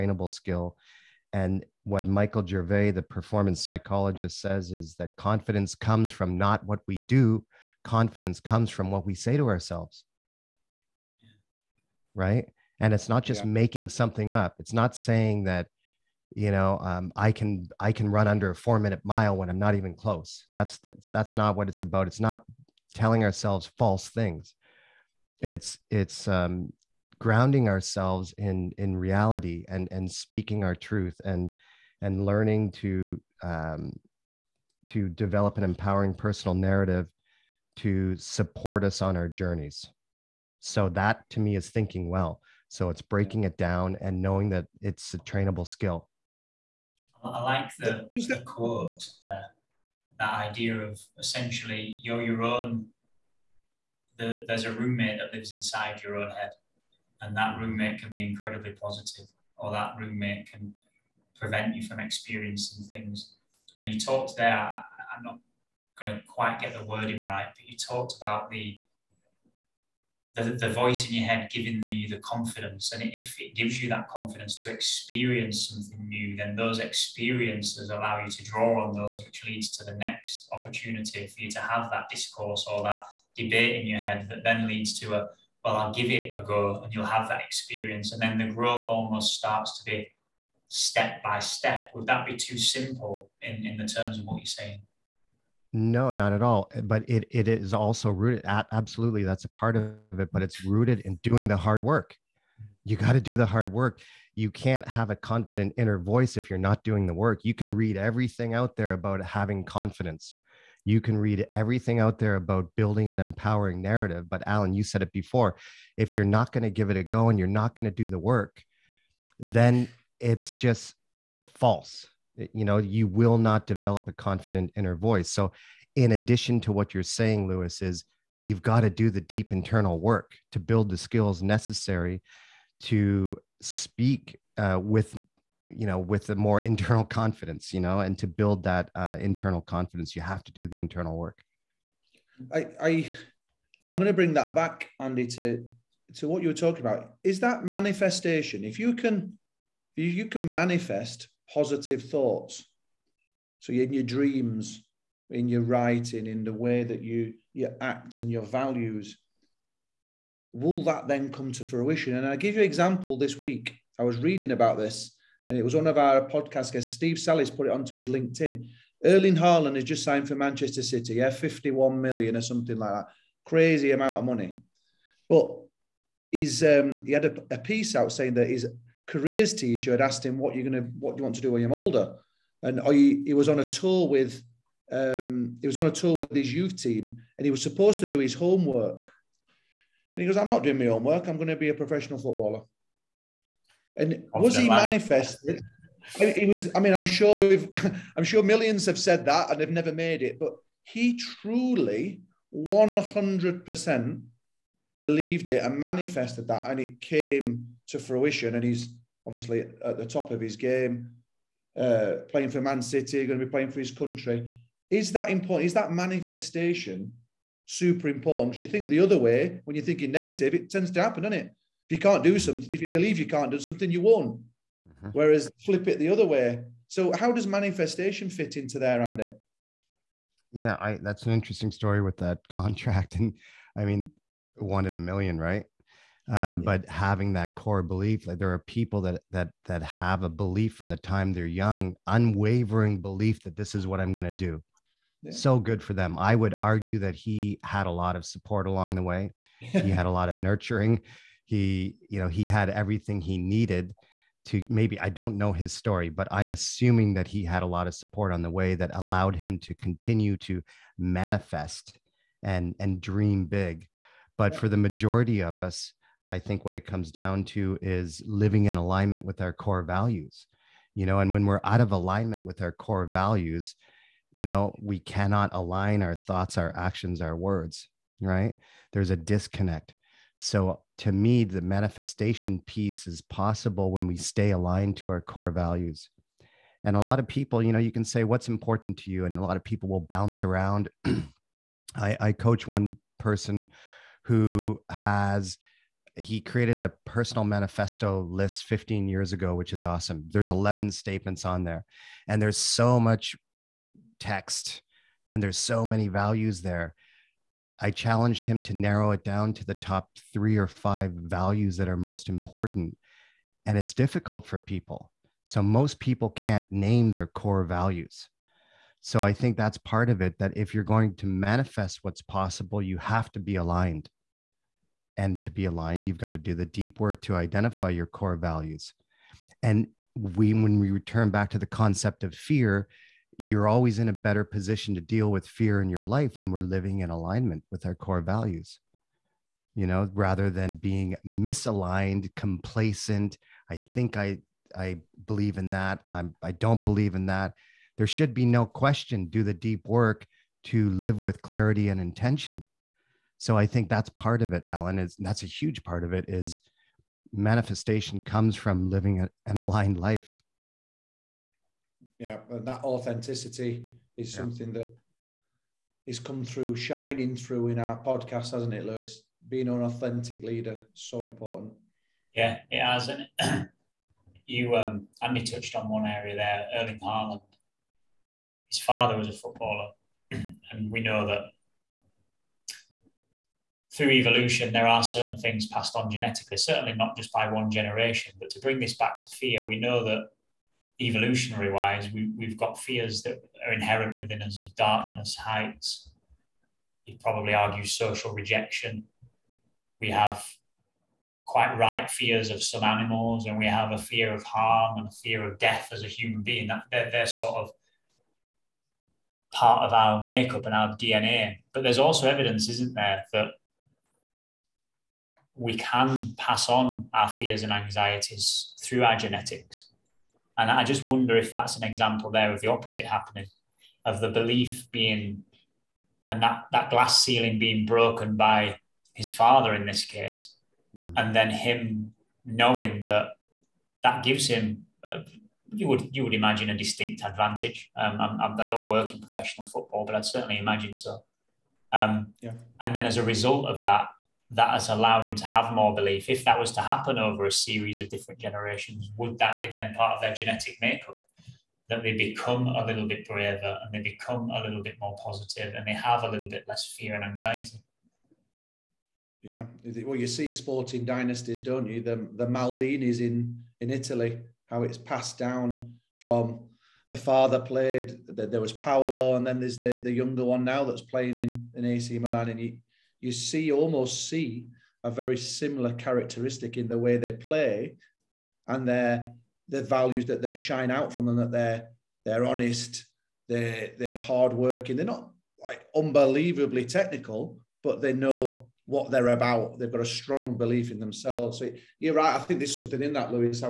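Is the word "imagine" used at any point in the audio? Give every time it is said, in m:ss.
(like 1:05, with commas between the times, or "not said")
7:16, 7:20.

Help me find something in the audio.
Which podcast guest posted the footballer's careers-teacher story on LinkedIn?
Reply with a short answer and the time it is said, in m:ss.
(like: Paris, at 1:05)
Steve Sallis, at 2:46.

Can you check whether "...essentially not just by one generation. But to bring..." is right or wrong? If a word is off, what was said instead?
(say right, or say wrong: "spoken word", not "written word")
wrong: "certainly", not "essentially".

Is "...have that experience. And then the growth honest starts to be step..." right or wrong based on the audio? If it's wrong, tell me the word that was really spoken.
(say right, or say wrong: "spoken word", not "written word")
wrong: "almost", not "honest".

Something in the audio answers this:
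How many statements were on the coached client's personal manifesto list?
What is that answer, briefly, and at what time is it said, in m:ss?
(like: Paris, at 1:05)
11, at 5:00.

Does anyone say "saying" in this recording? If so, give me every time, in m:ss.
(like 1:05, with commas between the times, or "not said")
0:14, 1:34, 2:07, 2:58.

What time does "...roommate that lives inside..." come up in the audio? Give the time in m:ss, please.
0:54.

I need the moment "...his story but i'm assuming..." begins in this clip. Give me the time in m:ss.
4:15.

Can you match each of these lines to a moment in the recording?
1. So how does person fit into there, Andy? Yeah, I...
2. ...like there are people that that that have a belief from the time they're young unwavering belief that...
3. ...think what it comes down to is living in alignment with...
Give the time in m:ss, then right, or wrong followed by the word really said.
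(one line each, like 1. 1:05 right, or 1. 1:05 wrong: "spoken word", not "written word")
1. 3:46 wrong: "manifestation", not "person"
2. 3:58 right
3. 4:26 right.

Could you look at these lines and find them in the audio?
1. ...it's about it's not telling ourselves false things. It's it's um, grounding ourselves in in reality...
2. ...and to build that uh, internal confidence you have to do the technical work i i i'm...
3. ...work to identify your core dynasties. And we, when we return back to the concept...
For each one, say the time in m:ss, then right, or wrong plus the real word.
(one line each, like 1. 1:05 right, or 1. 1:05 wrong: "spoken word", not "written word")
1. 0:21 right
2. 2:17 wrong: "internal", not "technical"
3. 5:26 wrong: "values", not "dynasties".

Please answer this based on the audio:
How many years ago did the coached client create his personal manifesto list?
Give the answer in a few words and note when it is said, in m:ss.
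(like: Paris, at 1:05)
15, at 4:58.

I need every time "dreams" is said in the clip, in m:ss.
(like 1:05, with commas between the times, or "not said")
2:34, 4:23.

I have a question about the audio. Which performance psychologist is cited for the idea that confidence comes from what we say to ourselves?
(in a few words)
Michael Gervais.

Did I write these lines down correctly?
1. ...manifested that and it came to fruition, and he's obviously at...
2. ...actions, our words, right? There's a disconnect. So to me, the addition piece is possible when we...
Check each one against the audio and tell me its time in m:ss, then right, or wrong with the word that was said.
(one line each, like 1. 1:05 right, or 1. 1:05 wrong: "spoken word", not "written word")
1. 3:25 right
2. 4:36 wrong: "manifestation", not "addition".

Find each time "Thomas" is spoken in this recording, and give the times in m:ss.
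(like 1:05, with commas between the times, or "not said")
not said.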